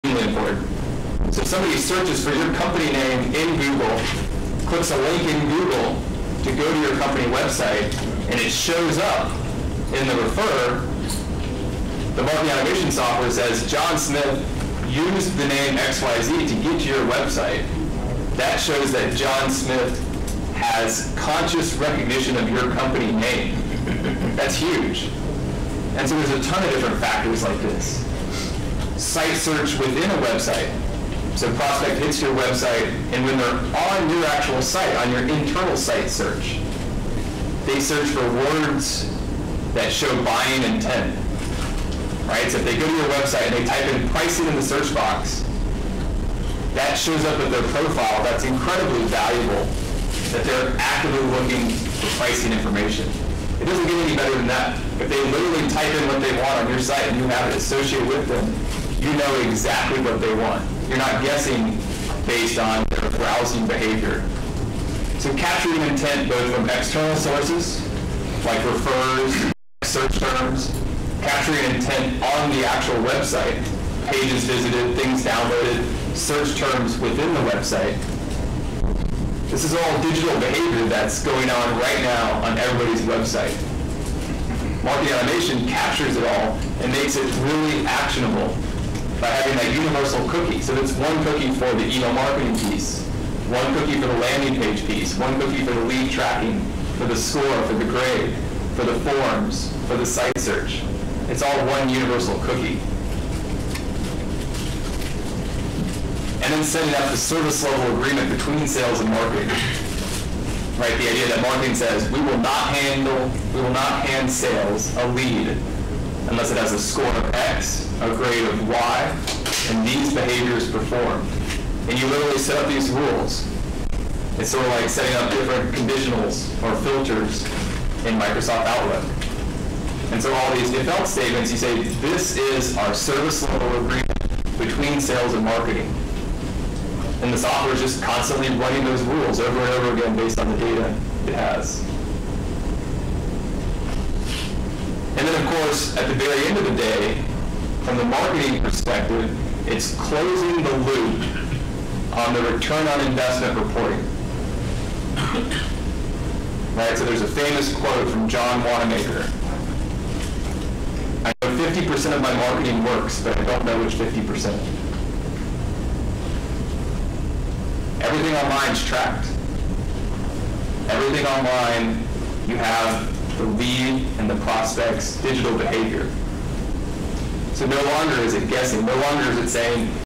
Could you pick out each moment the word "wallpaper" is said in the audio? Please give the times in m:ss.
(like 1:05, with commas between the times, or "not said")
not said.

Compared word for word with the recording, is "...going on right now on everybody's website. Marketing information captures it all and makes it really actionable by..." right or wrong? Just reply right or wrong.
wrong.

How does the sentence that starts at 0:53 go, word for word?
It doesn't get any better than that.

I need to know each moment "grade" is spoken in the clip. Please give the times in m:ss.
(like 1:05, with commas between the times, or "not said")
1:37, 1:58.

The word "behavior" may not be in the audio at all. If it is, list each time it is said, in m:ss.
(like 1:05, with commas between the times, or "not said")
1:03, 1:20, 2:55.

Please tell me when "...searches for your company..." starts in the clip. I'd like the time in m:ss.
0:01.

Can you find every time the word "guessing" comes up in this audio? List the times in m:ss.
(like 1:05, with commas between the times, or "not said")
1:01, 2:58.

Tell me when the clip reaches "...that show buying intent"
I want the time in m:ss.
0:39.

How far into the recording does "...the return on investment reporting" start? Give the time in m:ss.
2:32.